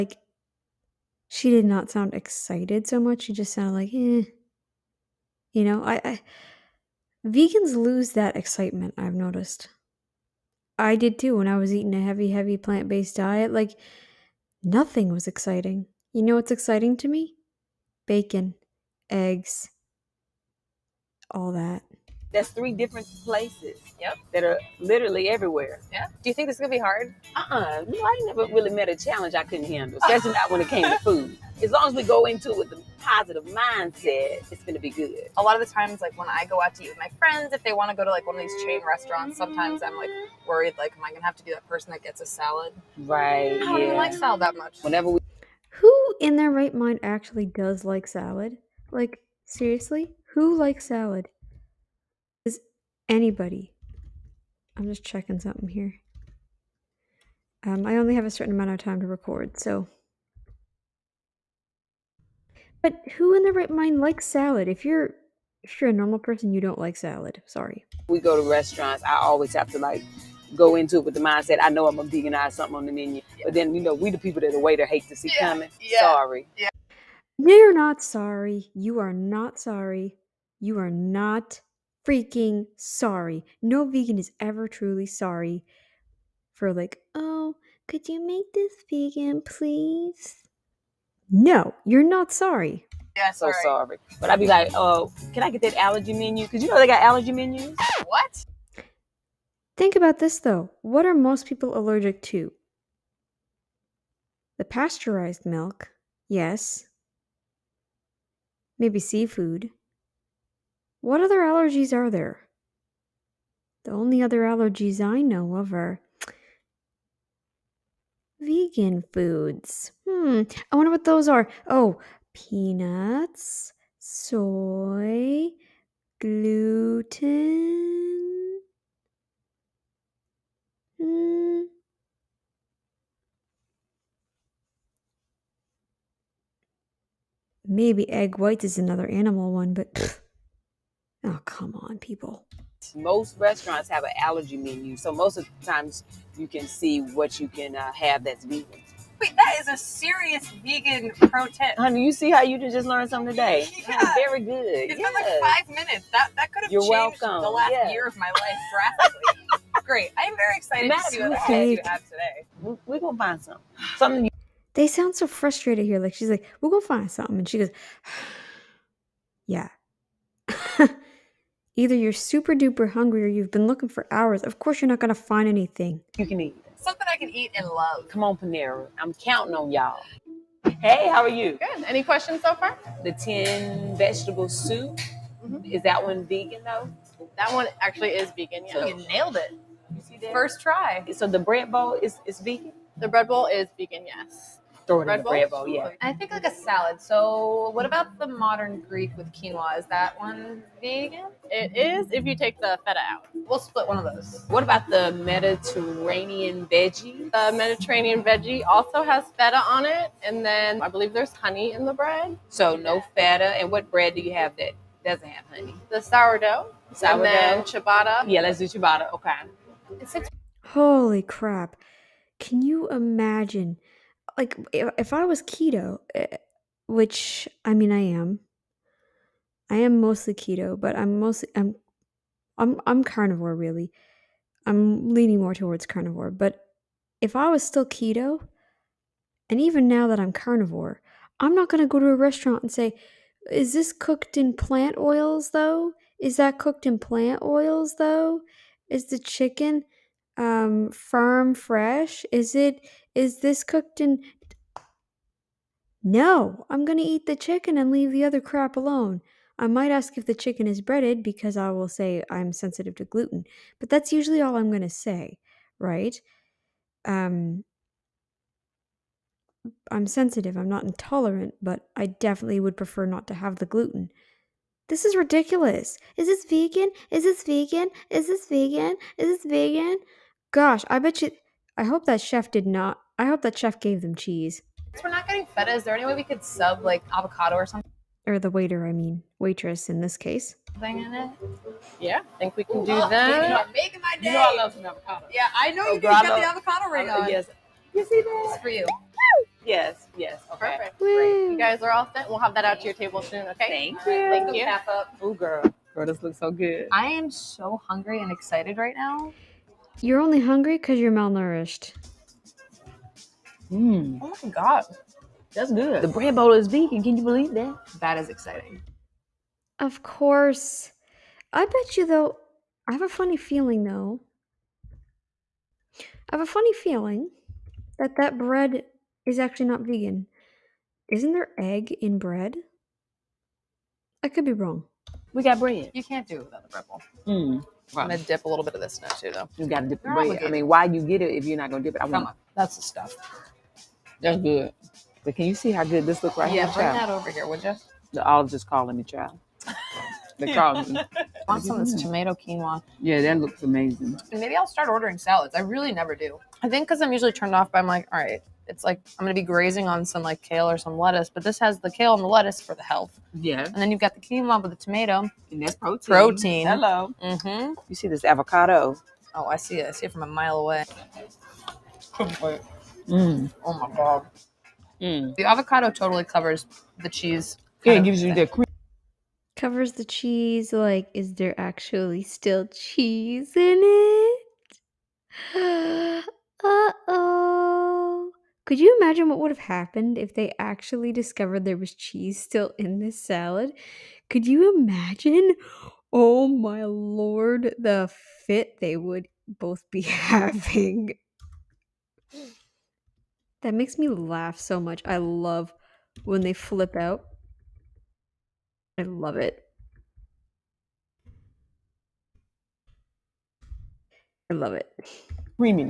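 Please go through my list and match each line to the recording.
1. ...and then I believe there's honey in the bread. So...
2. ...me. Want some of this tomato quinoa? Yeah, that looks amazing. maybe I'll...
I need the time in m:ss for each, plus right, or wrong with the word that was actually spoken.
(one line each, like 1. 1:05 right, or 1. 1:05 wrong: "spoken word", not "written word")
1. 3:30 right
2. 5:50 right.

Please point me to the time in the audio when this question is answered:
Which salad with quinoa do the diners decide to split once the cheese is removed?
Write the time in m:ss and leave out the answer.
3:18.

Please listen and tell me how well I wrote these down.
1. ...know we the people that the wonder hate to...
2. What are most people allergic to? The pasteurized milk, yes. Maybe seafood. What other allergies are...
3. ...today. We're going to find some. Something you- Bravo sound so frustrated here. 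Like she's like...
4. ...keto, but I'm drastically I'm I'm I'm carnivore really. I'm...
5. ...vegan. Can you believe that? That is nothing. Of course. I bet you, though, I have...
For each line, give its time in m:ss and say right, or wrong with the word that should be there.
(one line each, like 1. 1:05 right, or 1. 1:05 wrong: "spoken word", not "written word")
1. 1:13 wrong: "waiter", not "wonder"
2. 1:40 right
3. 2:42 wrong: "They", not "Bravo"
4. 3:50 wrong: "mostly", not "drastically"
5. 5:16 wrong: "exciting", not "nothing".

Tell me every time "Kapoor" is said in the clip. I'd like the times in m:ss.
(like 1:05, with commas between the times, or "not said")
not said.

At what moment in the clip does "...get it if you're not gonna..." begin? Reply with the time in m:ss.
5:41.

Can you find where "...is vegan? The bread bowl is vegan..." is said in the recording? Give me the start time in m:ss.
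3:12.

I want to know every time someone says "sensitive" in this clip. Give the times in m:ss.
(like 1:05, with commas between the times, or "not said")
4:22, 4:30.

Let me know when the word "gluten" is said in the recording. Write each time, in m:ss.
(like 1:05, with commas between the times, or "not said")
2:06, 4:23, 4:33.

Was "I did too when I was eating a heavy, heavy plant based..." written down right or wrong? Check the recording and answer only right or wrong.
right.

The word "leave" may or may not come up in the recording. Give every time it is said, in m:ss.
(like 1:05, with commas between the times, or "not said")
4:17.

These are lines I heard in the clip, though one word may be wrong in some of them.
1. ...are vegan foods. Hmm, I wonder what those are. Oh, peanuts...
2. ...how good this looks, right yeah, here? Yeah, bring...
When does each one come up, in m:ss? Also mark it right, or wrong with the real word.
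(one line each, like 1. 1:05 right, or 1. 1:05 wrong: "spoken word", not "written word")
1. 1:55 right
2. 5:45 right.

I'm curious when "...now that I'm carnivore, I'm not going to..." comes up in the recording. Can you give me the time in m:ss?
3:59.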